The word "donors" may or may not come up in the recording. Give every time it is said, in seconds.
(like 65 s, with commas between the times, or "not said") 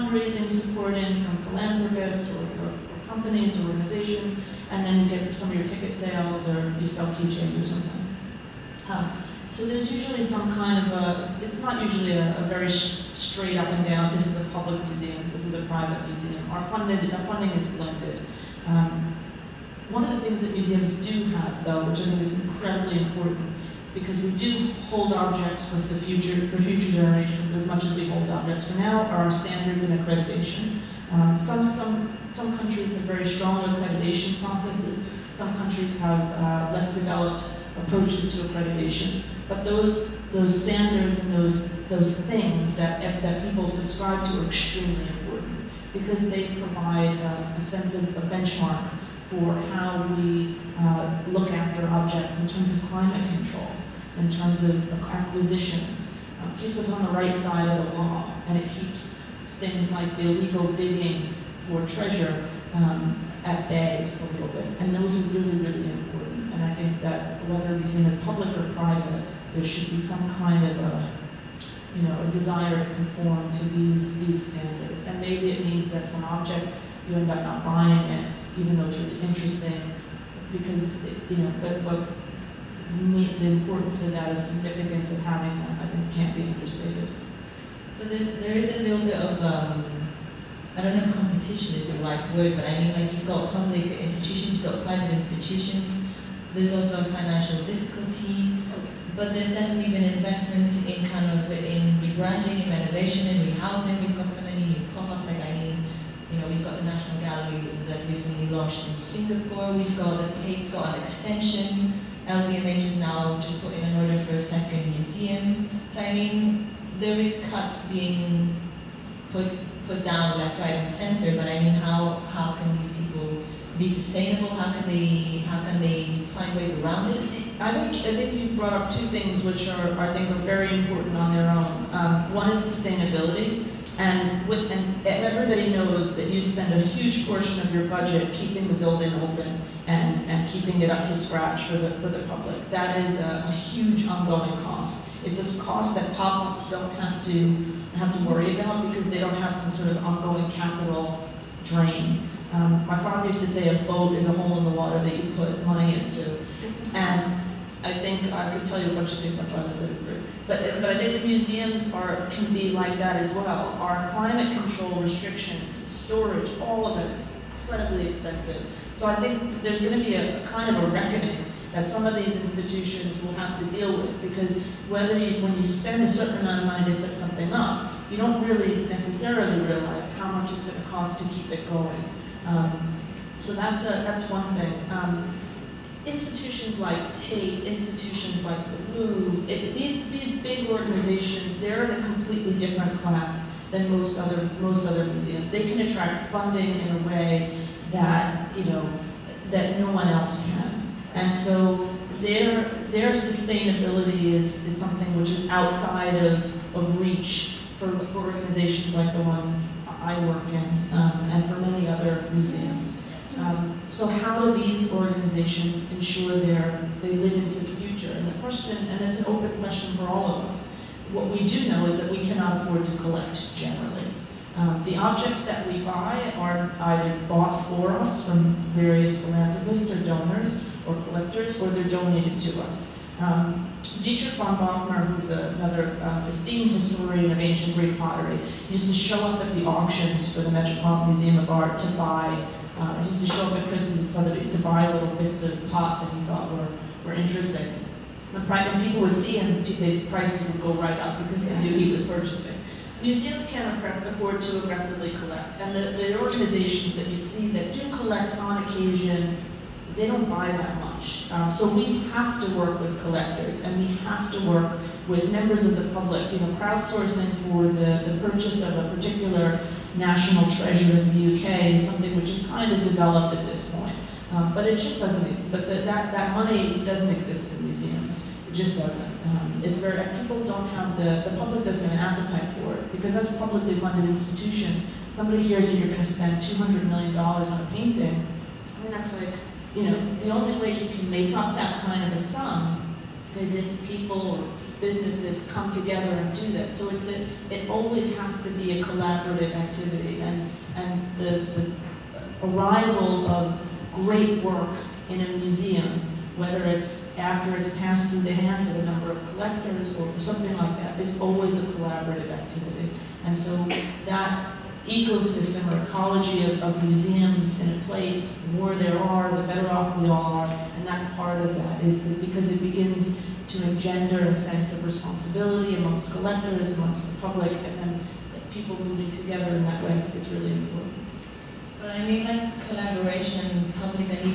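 230 s.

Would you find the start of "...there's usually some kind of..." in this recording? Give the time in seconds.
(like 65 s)
9 s.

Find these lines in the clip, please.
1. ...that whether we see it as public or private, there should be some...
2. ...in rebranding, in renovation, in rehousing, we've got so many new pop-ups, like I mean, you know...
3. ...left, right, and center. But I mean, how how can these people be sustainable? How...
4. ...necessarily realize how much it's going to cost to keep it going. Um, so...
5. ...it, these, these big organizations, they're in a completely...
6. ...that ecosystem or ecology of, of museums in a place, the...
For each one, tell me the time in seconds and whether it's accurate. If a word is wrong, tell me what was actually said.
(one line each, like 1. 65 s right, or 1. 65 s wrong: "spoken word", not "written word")
1. 67 s right
2. 101 s right
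3. 120 s right
4. 178 s right
5. 189 s right
6. 314 s right.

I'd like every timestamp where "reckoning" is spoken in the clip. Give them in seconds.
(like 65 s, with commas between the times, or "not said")
170 s.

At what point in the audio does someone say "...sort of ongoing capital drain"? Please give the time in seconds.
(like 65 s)
149 s.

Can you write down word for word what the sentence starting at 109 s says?
We've got a Tate's got an extension.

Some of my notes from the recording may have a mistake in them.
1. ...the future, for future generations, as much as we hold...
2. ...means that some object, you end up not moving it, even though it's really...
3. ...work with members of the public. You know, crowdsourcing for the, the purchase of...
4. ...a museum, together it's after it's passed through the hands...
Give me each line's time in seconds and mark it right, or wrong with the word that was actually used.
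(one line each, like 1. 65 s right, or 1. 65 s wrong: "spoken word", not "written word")
1. 25 s right
2. 75 s wrong: "buying", not "moving"
3. 264 s right
4. 305 s wrong: "whether", not "together".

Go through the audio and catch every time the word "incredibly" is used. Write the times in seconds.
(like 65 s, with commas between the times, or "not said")
22 s, 167 s.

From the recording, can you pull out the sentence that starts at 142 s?
That is a, a huge ongoing cost.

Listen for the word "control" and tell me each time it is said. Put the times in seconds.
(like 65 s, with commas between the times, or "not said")
53 s, 164 s.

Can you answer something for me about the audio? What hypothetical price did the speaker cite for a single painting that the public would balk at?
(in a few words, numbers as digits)
$200 million.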